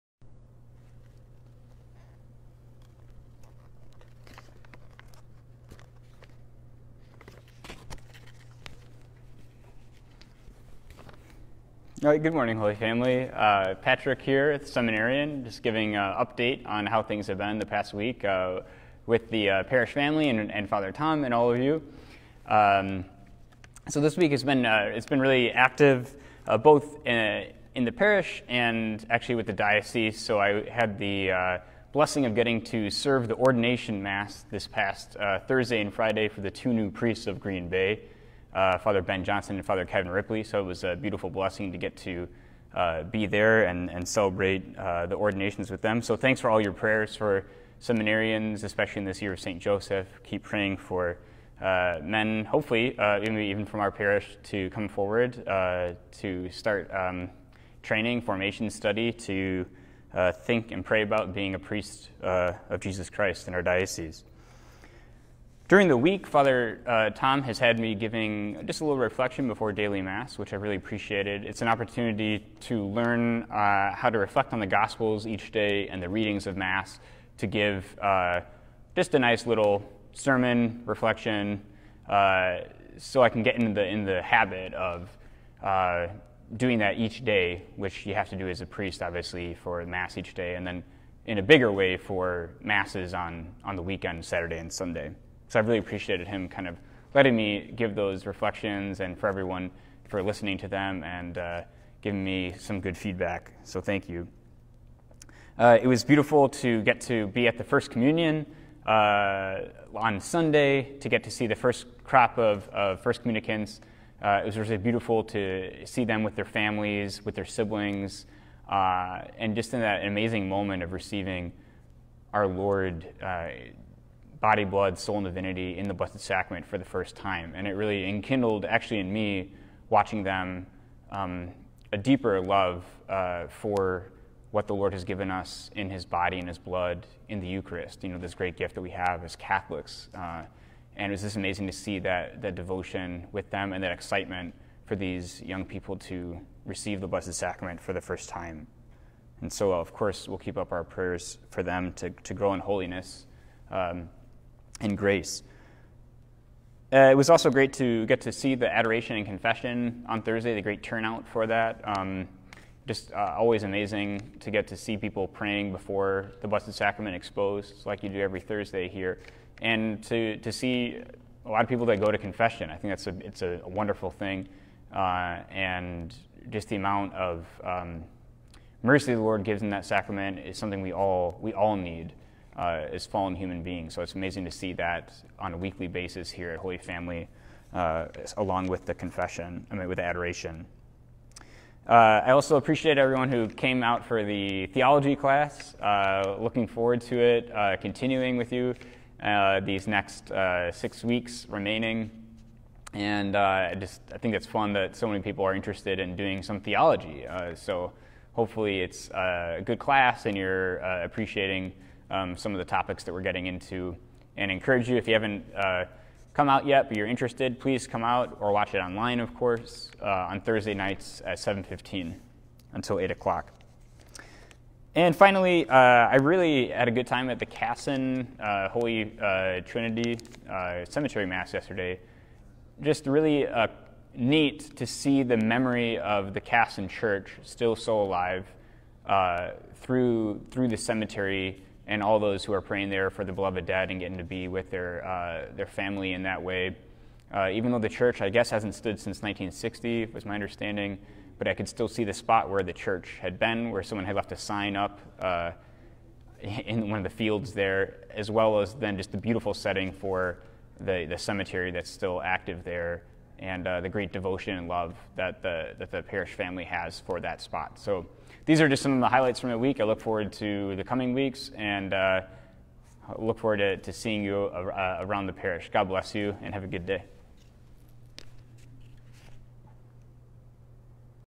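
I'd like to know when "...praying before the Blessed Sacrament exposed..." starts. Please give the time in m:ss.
2:45.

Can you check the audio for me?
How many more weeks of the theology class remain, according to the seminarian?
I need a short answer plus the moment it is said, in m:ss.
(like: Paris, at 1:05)
6, at 3:20.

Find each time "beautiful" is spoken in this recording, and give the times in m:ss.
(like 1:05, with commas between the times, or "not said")
0:40, 1:46, 1:54, 4:19.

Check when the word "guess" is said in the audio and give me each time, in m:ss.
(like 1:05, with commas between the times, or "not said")
4:08.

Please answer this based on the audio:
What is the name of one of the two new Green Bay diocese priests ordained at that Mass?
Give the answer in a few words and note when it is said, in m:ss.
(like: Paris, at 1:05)
Father Kevin Ripley, at 0:39.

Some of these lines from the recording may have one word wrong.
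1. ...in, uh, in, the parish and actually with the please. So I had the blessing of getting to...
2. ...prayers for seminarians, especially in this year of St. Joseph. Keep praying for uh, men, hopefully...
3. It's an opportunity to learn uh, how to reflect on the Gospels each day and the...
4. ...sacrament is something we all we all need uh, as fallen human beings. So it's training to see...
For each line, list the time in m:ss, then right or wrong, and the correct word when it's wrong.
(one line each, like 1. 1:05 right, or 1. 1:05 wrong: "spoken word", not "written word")
1. 0:27 wrong: "diocese", not "please"
2. 0:46 right
3. 1:11 right
4. 2:59 wrong: "amazing", not "training".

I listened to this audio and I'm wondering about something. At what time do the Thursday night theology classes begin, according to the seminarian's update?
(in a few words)
7:15.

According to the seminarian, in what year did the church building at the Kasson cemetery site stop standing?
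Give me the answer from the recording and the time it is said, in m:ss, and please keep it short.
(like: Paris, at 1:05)
1960, at 4:09.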